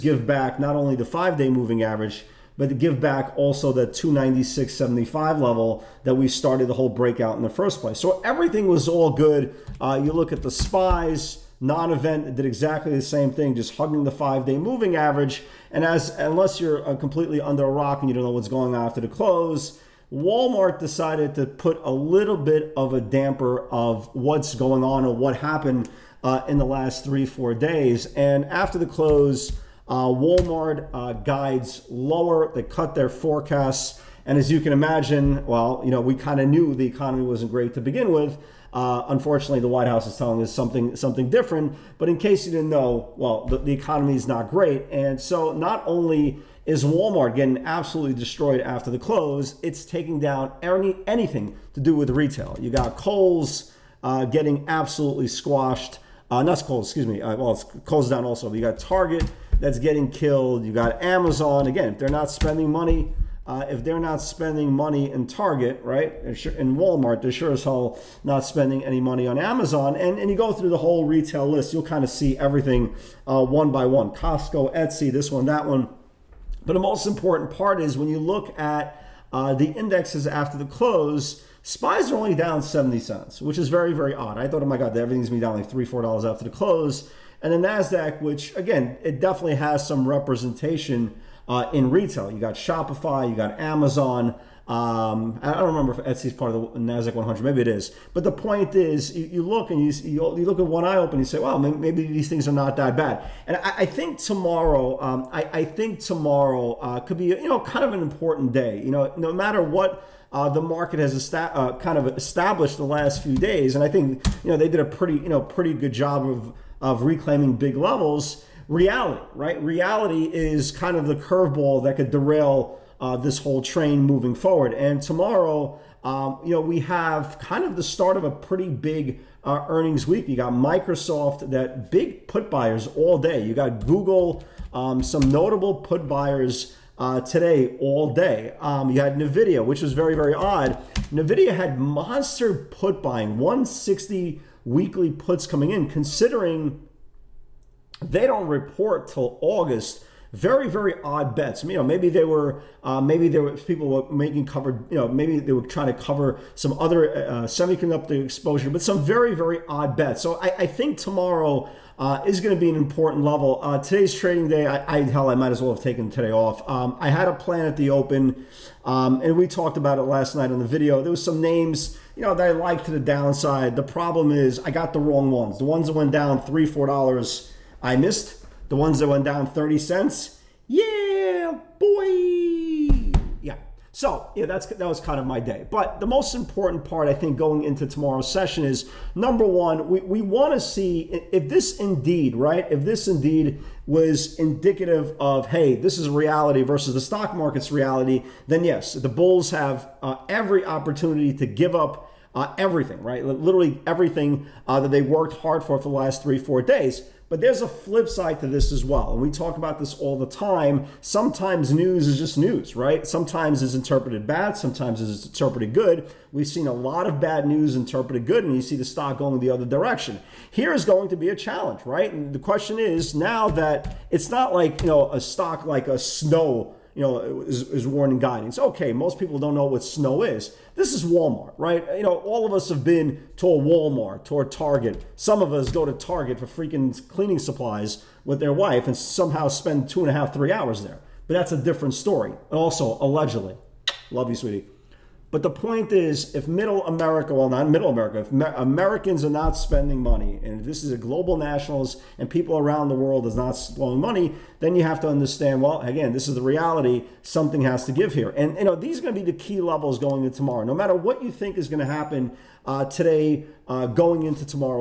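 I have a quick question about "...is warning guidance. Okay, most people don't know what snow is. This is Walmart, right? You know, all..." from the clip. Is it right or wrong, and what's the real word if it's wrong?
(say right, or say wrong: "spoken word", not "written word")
right.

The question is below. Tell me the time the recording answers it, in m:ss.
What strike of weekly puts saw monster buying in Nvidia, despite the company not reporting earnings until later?
2:23.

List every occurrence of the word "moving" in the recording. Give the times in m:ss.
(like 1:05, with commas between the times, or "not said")
0:01, 0:14, 2:04.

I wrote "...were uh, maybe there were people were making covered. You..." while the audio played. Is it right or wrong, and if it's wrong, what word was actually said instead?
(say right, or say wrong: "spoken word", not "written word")
right.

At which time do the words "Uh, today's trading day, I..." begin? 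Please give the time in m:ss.
2:43.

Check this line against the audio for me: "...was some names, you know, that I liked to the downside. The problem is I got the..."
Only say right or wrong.
right.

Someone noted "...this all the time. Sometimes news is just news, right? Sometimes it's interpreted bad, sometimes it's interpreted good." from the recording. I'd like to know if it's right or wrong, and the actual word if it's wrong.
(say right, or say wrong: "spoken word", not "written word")
right.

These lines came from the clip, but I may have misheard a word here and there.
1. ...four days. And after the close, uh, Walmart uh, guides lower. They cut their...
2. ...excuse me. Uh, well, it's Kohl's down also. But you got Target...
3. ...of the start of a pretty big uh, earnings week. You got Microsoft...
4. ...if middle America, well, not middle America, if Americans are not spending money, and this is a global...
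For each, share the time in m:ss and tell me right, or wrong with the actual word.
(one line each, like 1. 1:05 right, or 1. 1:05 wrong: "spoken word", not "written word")
1. 0:27 right
2. 0:56 right
3. 2:07 right
4. 4:06 right.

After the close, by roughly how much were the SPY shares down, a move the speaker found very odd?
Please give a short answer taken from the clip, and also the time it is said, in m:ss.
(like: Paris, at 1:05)
70 cents, at 1:22.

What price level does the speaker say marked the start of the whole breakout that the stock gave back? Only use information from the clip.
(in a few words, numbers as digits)
296.75.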